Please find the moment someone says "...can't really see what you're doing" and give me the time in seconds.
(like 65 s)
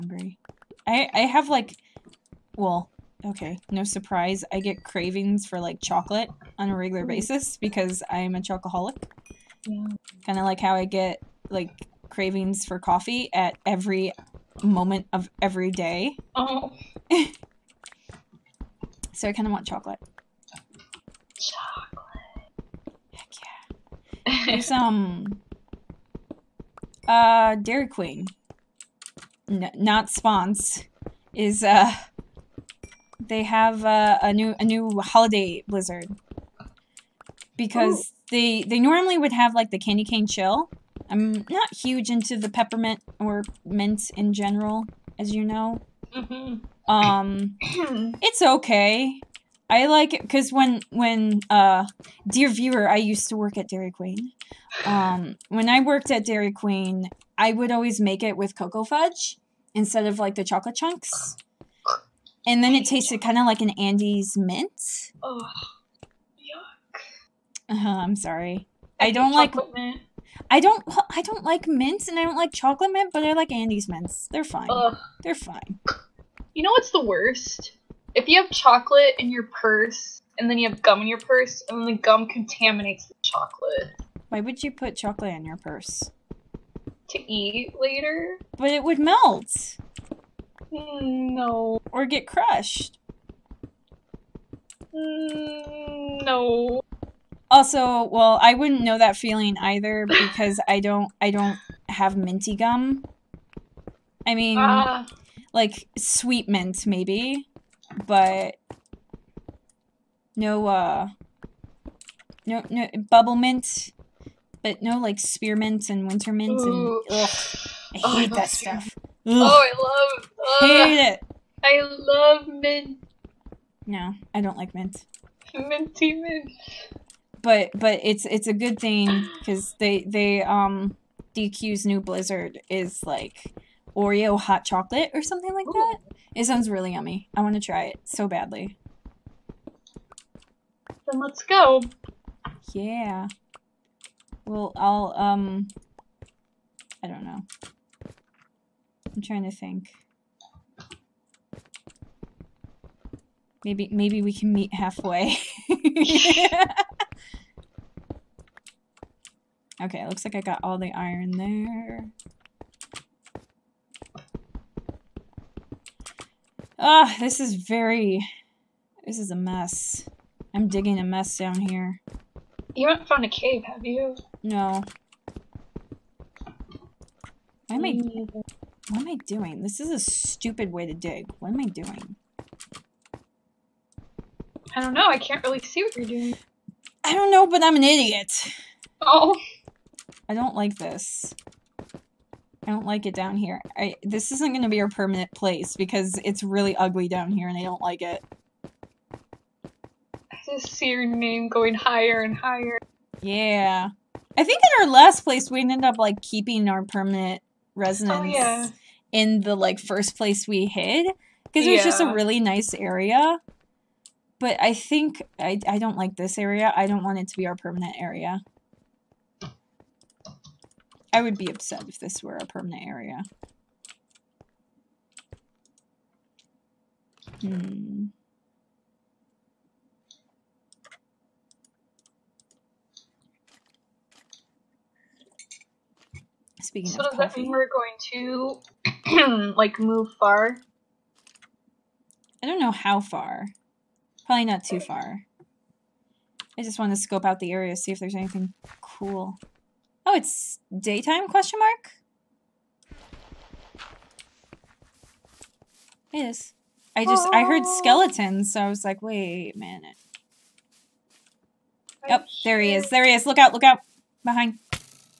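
185 s.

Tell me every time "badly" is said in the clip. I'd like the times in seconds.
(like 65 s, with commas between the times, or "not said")
138 s.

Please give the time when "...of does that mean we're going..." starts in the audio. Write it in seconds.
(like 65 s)
237 s.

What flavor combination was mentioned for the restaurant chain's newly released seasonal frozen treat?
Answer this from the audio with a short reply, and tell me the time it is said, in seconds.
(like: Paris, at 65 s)
Oreo hot chocolate, at 133 s.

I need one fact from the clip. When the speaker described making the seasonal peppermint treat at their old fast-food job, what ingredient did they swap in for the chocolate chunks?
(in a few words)
cocoa fudge.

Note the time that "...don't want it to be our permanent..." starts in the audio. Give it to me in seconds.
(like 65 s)
216 s.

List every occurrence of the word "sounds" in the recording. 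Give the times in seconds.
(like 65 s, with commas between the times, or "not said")
136 s.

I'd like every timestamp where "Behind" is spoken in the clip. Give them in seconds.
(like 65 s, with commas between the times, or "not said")
264 s.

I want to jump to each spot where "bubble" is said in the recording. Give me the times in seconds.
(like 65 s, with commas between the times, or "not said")
113 s.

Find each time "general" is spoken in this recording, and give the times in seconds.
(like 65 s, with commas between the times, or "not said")
44 s.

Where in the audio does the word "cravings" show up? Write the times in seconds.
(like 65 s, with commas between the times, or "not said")
4 s, 12 s.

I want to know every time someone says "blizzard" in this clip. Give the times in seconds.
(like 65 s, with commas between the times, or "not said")
35 s, 132 s.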